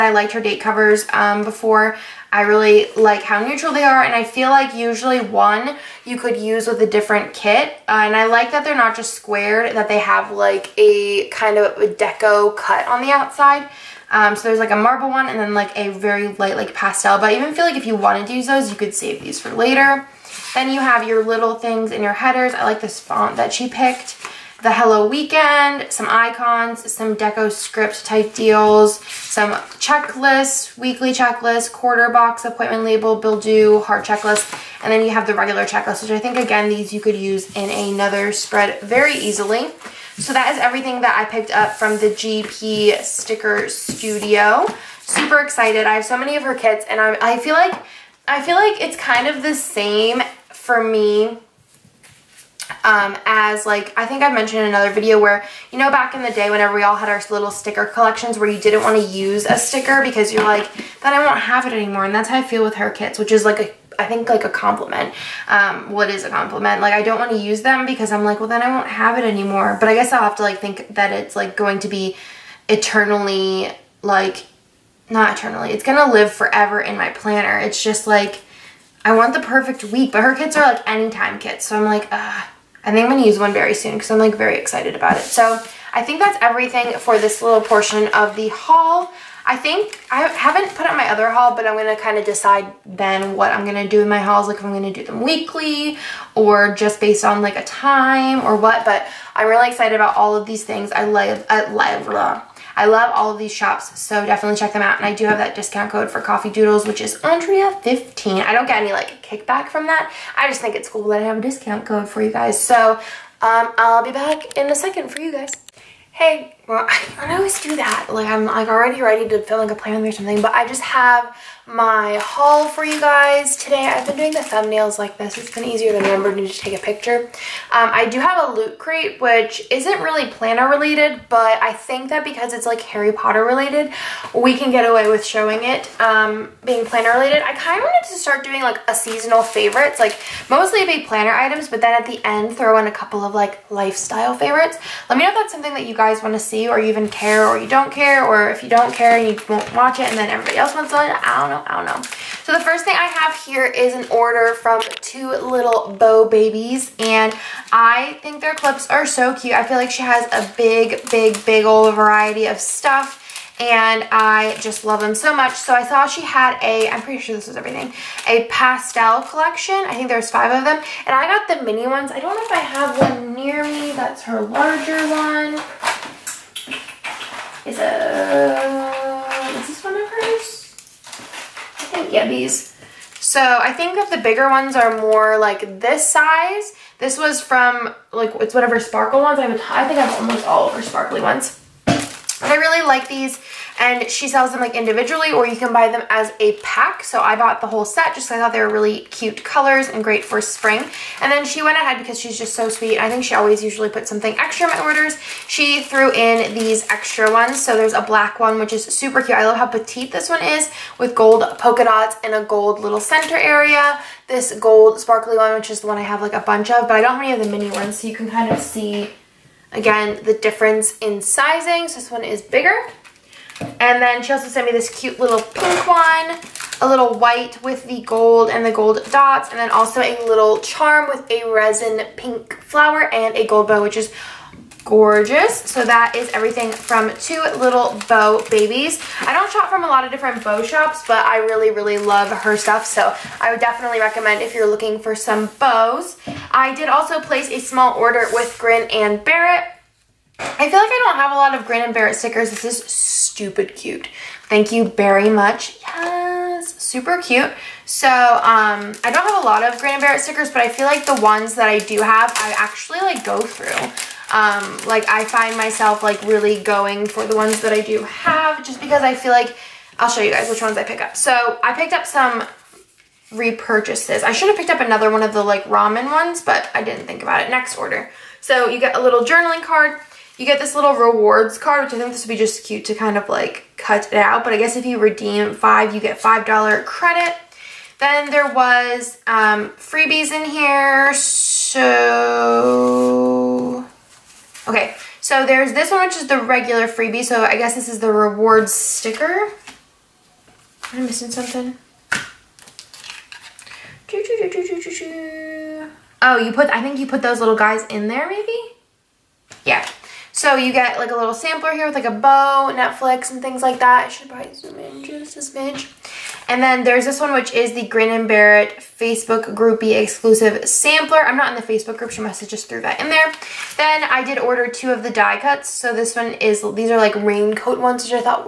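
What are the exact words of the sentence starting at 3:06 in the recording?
This was from like, it's whatever sparkle ones.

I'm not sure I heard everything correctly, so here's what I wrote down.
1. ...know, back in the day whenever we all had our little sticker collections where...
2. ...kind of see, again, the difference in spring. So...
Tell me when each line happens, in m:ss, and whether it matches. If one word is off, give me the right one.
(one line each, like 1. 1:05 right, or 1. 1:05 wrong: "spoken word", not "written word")
1. 0:55 right
2. 3:38 wrong: "sizing", not "spring".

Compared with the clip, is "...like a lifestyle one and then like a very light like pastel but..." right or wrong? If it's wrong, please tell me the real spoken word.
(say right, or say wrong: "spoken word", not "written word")
wrong: "marble", not "lifestyle".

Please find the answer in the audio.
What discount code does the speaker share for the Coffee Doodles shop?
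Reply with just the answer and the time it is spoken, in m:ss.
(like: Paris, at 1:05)
Andrea15, at 1:47.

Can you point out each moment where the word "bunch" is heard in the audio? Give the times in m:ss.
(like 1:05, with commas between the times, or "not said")
3:36.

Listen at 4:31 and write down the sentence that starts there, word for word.
So I picked up some repurchases.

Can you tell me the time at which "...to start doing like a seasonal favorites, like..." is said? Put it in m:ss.
2:18.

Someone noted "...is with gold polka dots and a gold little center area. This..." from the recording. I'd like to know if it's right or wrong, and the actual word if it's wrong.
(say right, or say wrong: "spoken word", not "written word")
right.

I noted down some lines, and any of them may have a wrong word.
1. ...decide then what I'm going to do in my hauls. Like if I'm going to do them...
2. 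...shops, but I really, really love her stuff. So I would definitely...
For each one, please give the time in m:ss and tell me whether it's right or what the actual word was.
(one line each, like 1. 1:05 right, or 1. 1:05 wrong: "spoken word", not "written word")
1. 1:32 right
2. 4:00 right.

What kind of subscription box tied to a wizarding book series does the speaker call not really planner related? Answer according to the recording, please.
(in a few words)
loot crate.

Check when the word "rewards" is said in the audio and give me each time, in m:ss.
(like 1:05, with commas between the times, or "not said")
4:40, 4:58.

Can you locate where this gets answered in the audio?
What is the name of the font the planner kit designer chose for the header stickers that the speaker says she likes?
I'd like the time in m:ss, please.
0:24.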